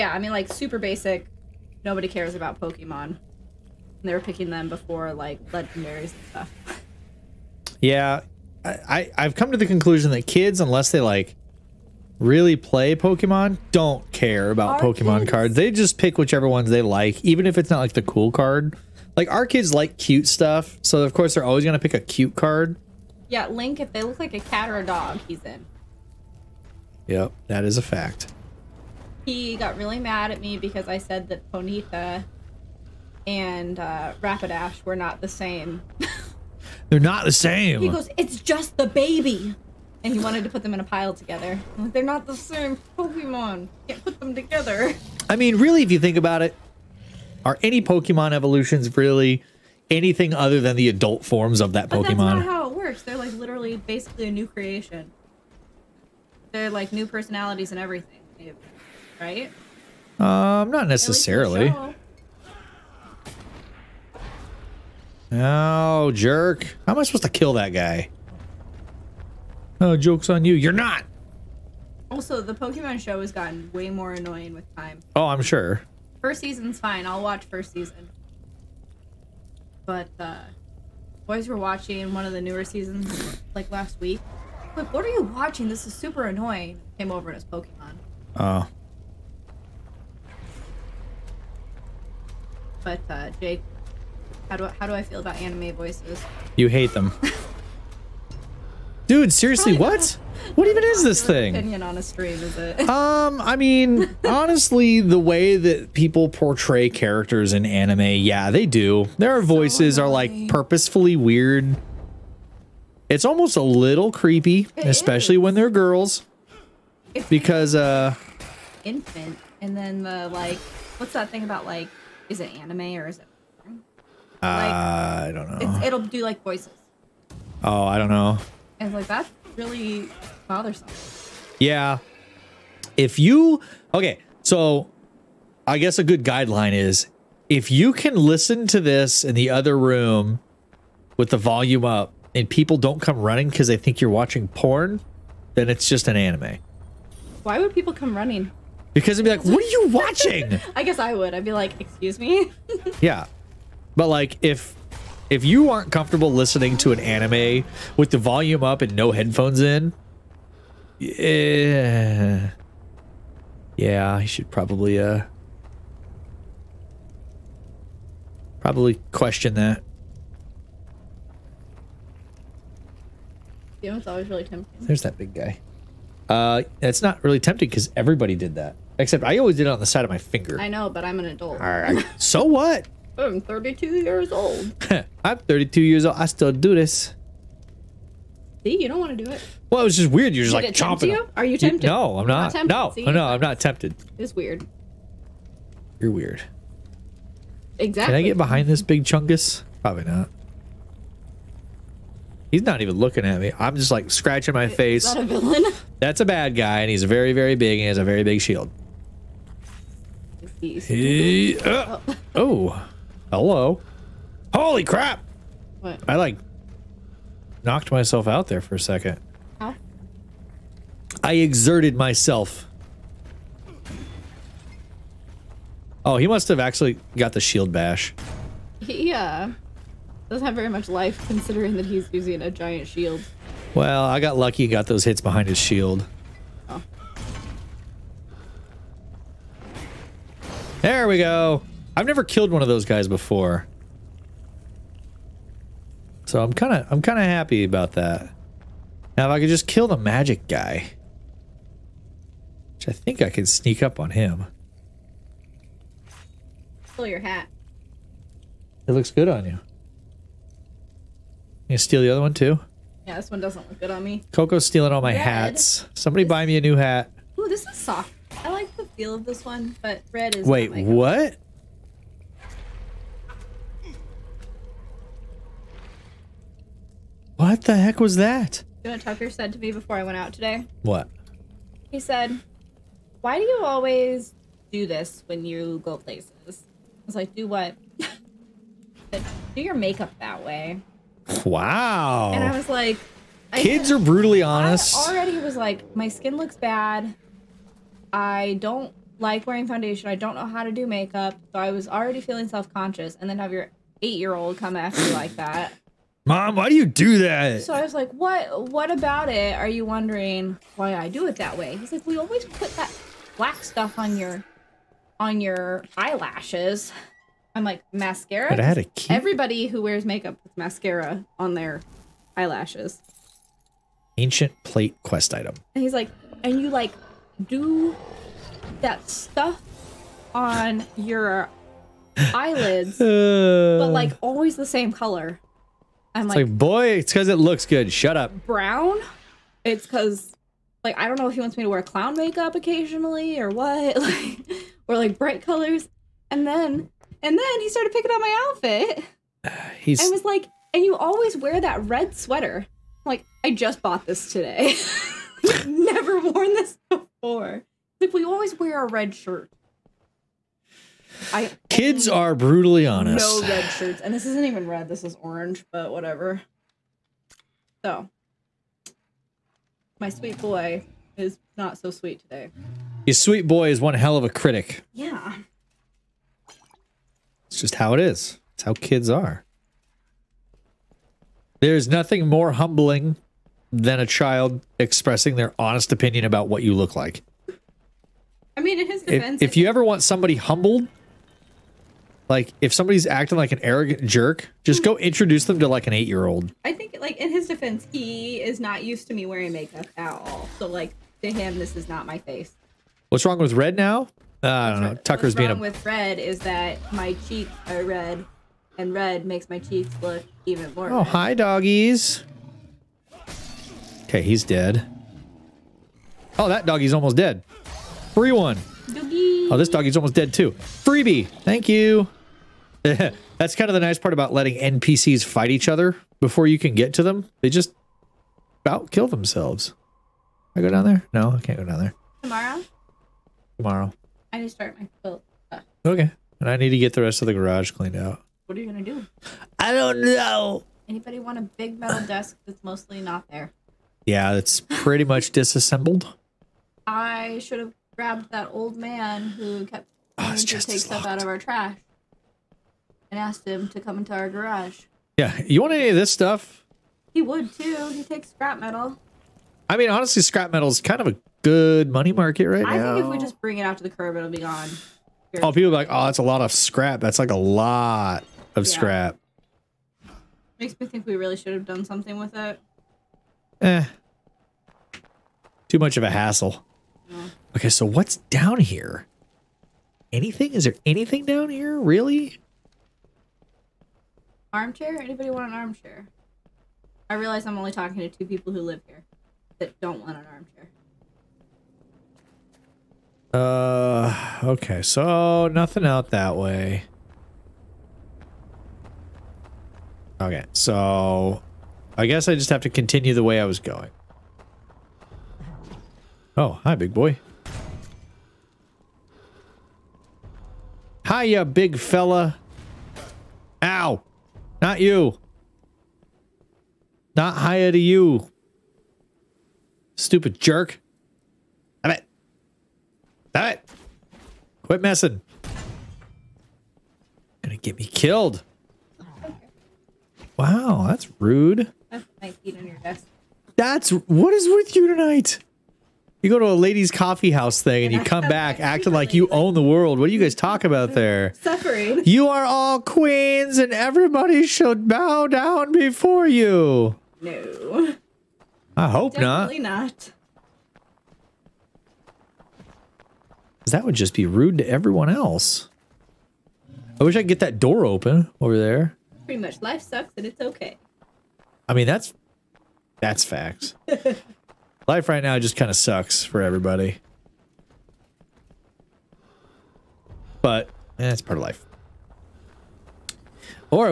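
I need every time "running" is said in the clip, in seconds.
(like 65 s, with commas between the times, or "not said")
143 s, 148 s.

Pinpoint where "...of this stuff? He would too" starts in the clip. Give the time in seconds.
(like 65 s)
455 s.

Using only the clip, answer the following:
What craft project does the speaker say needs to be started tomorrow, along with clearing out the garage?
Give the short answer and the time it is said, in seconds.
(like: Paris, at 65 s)
quilt, at 435 s.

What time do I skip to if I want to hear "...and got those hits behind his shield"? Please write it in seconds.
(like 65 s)
234 s.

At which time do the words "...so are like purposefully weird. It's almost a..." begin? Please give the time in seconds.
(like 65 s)
109 s.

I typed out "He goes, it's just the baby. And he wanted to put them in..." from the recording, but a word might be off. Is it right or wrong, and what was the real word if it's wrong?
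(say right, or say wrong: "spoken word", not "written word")
right.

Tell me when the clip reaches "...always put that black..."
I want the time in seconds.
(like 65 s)
312 s.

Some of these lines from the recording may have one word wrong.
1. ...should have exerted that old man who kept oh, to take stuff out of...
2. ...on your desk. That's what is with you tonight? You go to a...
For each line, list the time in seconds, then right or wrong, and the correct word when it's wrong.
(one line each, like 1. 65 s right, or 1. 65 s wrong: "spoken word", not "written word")
1. 447 s wrong: "grabbed", not "exerted"
2. 532 s right.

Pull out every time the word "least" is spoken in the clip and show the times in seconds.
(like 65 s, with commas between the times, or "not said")
not said.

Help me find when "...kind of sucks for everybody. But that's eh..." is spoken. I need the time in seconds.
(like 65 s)
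565 s.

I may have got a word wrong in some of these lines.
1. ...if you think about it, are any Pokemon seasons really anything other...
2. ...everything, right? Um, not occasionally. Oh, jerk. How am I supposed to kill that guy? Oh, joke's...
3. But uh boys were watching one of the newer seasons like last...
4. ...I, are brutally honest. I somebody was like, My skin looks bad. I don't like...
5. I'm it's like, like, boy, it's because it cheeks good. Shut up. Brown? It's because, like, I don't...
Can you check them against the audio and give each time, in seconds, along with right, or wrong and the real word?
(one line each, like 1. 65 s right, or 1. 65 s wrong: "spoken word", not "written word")
1. 45 s wrong: "evolutions", not "seasons"
2. 57 s wrong: "necessarily", not "occasionally"
3. 79 s right
4. 293 s wrong: "already", not "somebody"
5. 336 s wrong: "looks", not "cheeks".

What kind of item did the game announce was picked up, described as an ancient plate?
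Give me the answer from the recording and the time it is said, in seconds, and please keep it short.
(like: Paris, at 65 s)
quest item, at 325 s.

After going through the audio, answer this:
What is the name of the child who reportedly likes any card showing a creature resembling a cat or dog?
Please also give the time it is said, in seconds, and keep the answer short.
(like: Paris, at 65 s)
Link, at 23 s.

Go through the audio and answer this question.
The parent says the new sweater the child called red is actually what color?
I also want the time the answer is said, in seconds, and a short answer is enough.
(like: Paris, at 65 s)
orange, at 365 s.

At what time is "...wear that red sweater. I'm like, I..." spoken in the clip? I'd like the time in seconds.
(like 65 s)
351 s.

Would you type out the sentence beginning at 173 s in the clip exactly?
You know, it's always really tempting.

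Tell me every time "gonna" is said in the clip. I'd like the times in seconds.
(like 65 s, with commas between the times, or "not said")
21 s, 527 s.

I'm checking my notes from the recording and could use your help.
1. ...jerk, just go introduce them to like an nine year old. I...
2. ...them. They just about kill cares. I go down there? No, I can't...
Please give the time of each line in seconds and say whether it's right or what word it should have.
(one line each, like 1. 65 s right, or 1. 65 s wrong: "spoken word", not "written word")
1. 394 s wrong: "eight", not "nine"
2. 427 s wrong: "themselves", not "cares".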